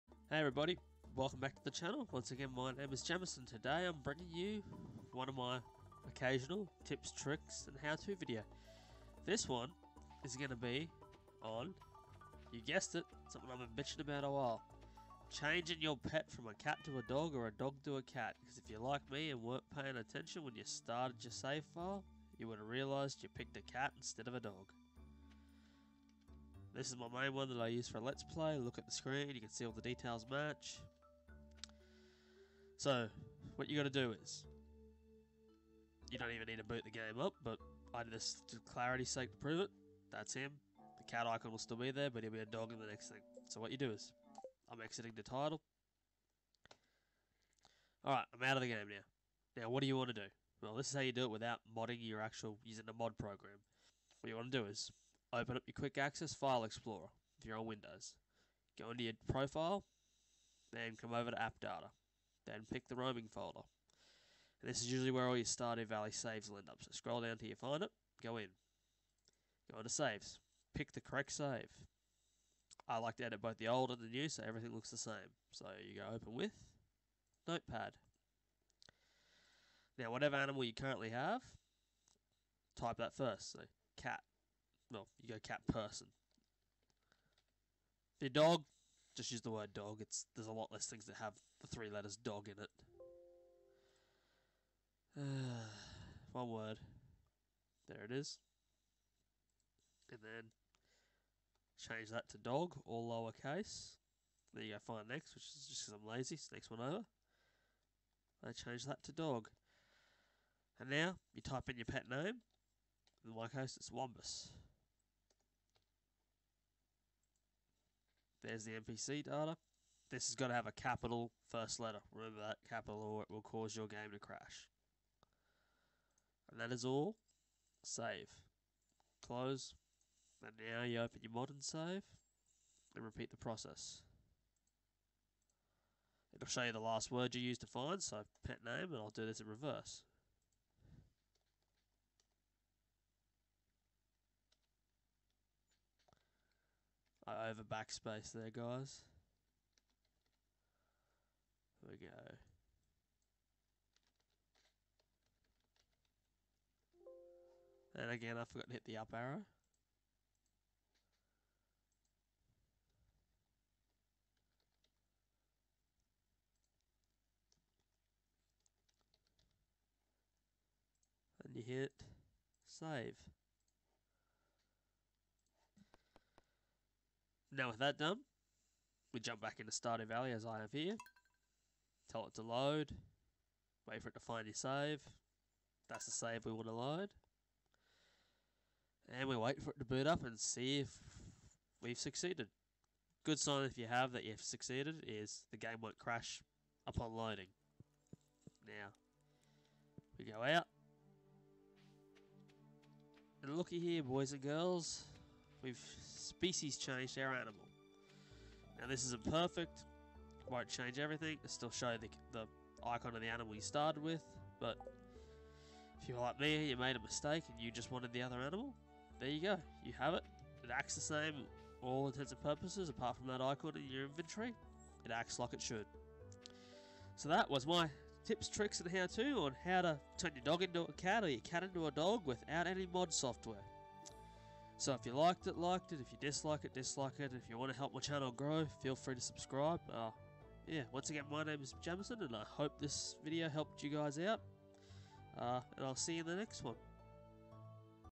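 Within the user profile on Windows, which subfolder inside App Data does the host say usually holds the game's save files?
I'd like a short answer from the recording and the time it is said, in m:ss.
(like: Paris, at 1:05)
Roaming, at 1:02.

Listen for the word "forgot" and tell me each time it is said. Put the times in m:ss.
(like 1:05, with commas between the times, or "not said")
2:38.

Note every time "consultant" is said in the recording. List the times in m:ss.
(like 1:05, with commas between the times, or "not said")
not said.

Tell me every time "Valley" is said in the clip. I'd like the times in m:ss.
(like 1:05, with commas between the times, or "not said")
1:05, 3:00.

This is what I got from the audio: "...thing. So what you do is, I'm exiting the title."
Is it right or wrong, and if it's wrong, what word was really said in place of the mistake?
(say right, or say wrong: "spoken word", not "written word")
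right.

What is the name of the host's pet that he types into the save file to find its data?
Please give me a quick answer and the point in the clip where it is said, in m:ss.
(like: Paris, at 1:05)
Wombus, at 1:53.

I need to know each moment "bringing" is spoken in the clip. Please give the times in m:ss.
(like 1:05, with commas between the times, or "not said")
0:04.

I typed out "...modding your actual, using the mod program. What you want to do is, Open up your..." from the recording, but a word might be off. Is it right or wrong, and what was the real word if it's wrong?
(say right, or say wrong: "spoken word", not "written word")
right.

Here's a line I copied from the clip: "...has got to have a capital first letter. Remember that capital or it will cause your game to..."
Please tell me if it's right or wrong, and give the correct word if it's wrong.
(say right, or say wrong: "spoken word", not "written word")
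right.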